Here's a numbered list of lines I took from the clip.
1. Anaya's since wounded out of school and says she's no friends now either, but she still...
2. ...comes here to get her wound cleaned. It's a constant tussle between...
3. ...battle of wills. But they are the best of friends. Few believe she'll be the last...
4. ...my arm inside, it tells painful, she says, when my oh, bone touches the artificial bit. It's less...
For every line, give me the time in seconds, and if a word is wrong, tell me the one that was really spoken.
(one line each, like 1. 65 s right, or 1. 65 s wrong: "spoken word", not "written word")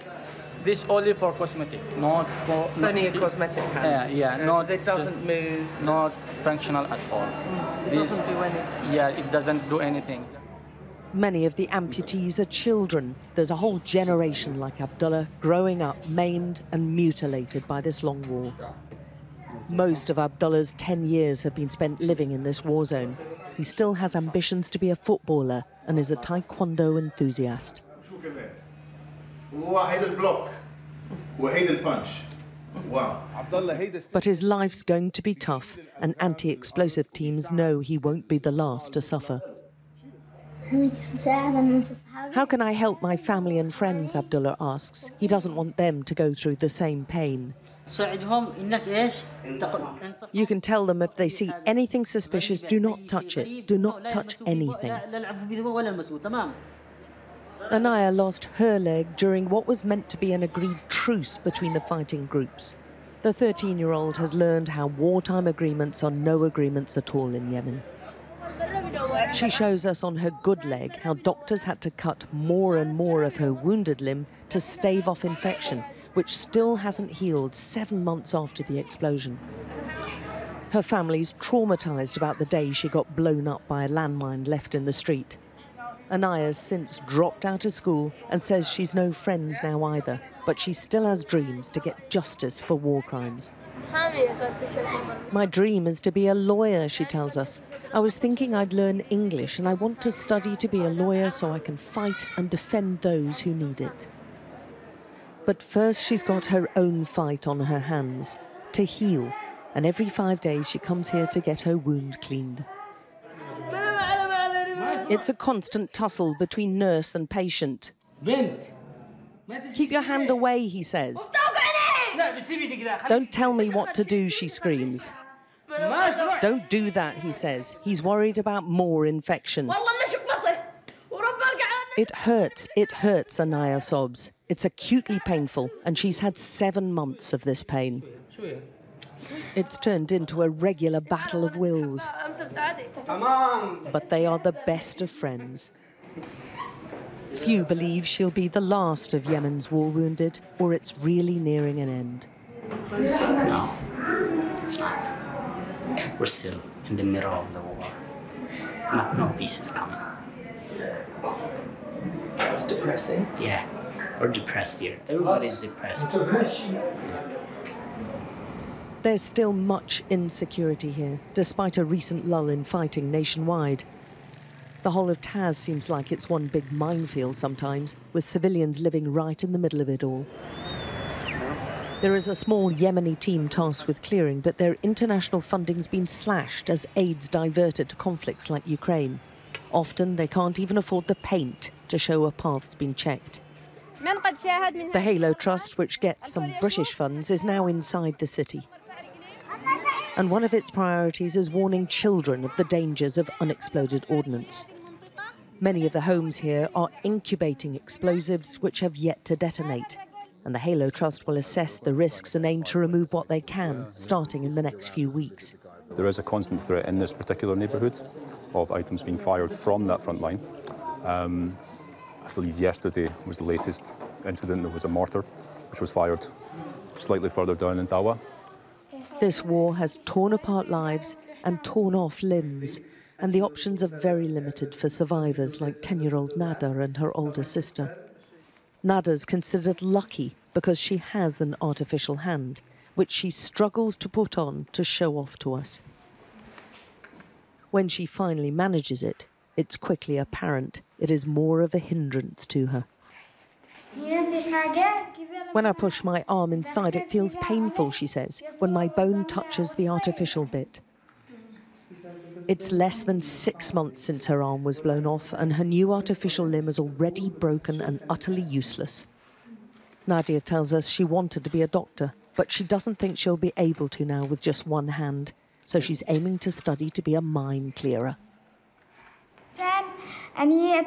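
1. 86 s wrong: "dropped", not "wounded"
2. 110 s right
3. 141 s right
4. 256 s wrong: "feels", not "tells".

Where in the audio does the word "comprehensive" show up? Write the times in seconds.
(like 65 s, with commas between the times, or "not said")
not said.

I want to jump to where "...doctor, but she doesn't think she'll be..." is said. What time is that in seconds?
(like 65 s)
271 s.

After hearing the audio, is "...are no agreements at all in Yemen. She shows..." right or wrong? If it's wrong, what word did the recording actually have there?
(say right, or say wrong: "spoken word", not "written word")
right.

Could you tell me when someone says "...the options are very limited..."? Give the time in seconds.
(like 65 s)
233 s.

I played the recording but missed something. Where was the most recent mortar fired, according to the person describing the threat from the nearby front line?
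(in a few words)
Dawa.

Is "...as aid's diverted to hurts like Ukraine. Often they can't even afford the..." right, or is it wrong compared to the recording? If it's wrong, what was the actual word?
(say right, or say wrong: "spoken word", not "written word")
wrong: "conflicts", not "hurts".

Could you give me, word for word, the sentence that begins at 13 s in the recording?
There's a whole generation like Abdullah growing up maimed and mutilated by this long war.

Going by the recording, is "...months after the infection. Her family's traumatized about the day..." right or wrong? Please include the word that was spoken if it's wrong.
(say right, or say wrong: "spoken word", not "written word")
wrong: "explosion", not "infection".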